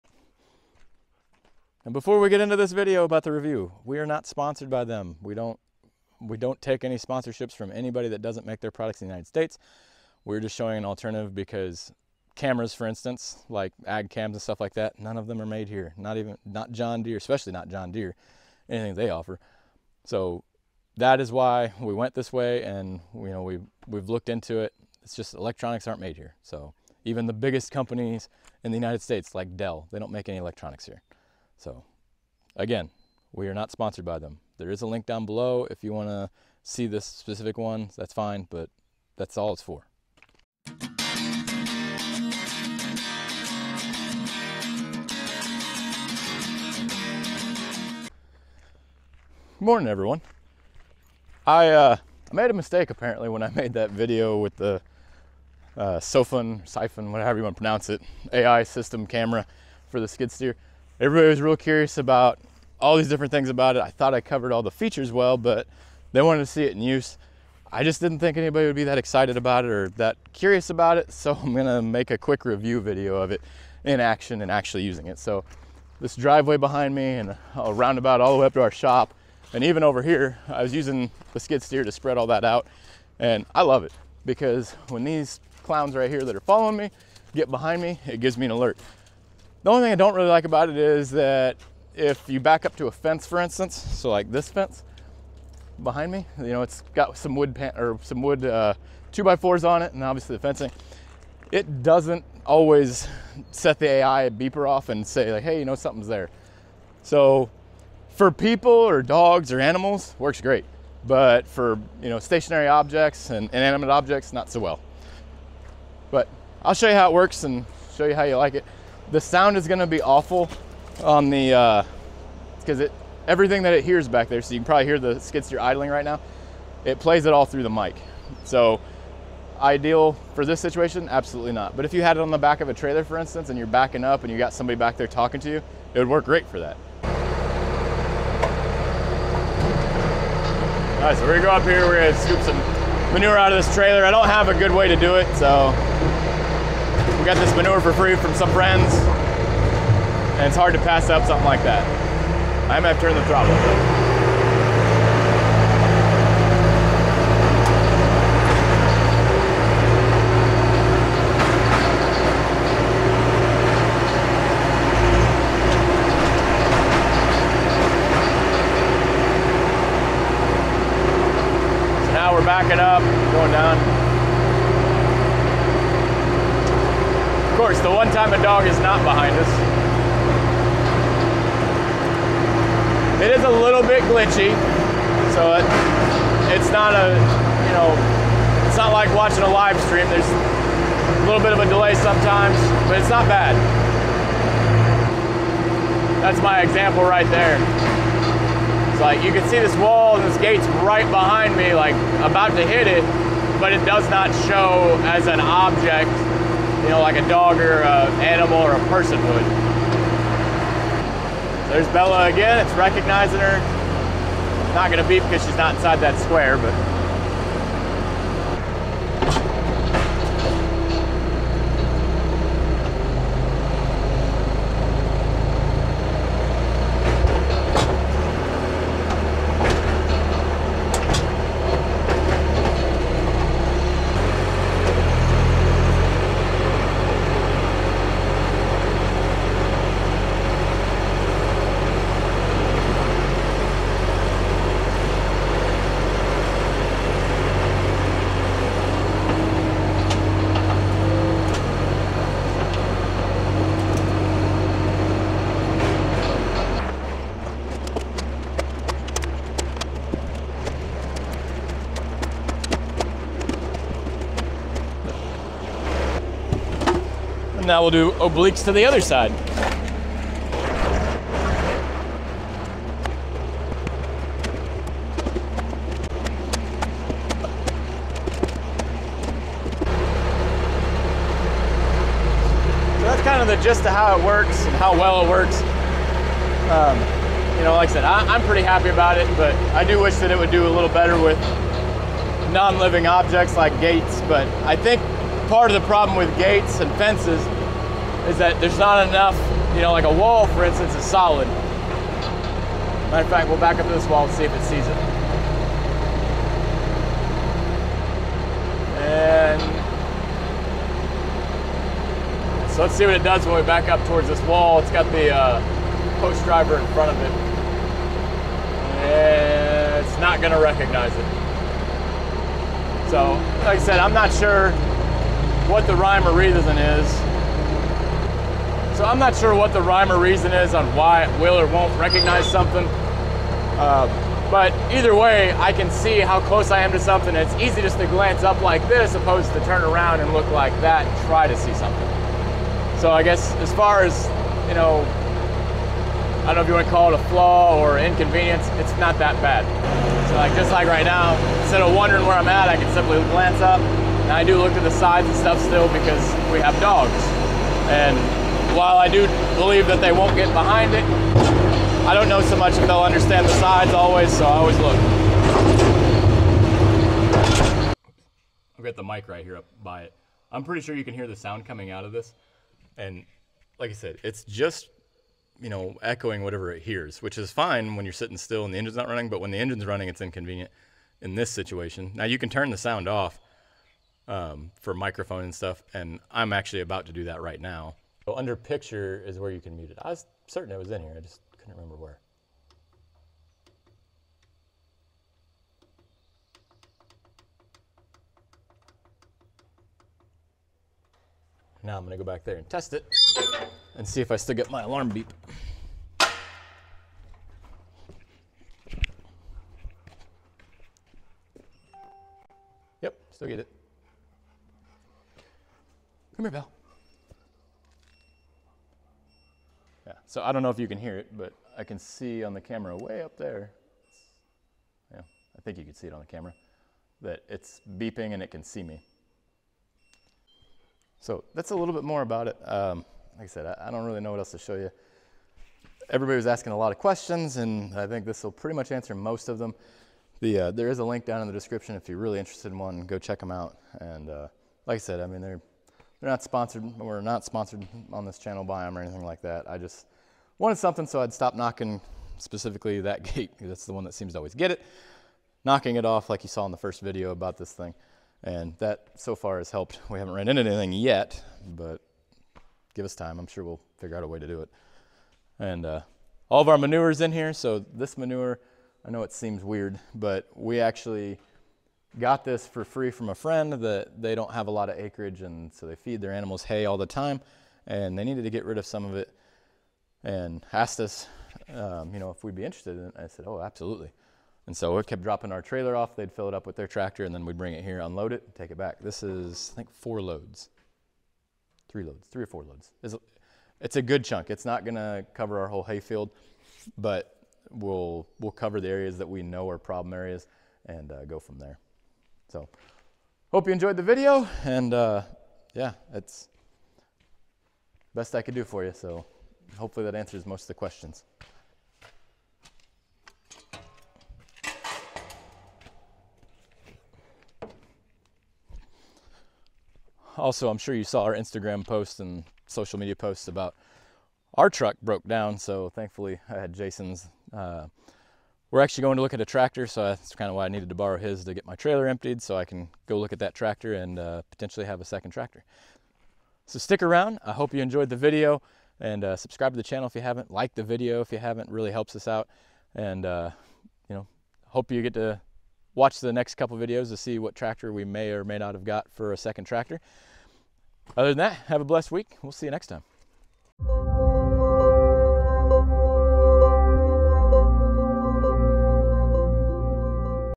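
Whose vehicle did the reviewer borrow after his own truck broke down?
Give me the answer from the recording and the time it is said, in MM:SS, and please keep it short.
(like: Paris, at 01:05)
Jason, at 08:46.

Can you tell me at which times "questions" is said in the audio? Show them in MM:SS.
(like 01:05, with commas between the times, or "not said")
07:16, 08:30.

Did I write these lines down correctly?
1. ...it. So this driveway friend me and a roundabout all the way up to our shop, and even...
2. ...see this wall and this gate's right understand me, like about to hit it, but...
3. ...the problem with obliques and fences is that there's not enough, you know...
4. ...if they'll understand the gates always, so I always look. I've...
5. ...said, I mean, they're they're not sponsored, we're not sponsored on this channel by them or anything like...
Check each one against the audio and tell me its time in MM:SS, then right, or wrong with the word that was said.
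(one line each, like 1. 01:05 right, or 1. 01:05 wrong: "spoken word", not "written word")
1. 01:15 wrong: "behind", not "friend"
2. 03:19 wrong: "behind", not "understand"
3. 04:55 wrong: "gates", not "obliques"
4. 06:02 wrong: "sides", not "gates"
5. 07:24 right.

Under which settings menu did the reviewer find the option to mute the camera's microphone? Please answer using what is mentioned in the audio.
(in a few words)
picture.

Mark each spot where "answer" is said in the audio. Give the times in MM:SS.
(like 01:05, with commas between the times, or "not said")
07:18, 08:30.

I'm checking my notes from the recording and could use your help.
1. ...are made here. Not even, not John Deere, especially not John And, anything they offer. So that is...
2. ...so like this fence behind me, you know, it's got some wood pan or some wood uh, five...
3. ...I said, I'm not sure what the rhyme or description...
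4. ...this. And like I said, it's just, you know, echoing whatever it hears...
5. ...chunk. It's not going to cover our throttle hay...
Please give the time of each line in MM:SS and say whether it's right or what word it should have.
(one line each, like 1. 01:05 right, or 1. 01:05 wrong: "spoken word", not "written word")
1. 00:15 wrong: "Deere", not "And"
2. 01:33 wrong: "two", not "five"
3. 05:23 wrong: "reason", not "description"
4. 06:12 right
5. 08:14 wrong: "whole", not "throttle".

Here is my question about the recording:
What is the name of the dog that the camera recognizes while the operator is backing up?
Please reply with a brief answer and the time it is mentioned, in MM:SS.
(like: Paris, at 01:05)
Bella, at 03:31.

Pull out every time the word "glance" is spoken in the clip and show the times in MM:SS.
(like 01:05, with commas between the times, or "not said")
05:38, 05:53.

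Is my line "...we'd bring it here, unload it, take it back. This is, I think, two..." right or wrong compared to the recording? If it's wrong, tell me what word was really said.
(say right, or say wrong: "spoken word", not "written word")
wrong: "four", not "two".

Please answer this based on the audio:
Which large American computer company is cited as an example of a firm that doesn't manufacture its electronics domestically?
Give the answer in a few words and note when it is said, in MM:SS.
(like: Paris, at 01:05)
Dell, at 00:29.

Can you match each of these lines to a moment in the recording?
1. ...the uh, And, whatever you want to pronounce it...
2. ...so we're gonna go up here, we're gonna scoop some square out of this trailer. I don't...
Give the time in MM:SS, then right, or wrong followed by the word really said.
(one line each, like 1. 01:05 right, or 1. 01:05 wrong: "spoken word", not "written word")
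1. 00:54 wrong: "Siphon", not "And"
2. 02:21 wrong: "manure", not "square".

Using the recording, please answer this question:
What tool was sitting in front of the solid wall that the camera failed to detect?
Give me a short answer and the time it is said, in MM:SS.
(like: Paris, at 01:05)
post driver, at 05:16.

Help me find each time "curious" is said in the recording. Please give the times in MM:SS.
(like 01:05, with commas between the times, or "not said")
01:01, 01:10.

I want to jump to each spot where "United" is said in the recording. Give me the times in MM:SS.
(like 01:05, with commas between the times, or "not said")
00:09, 00:28.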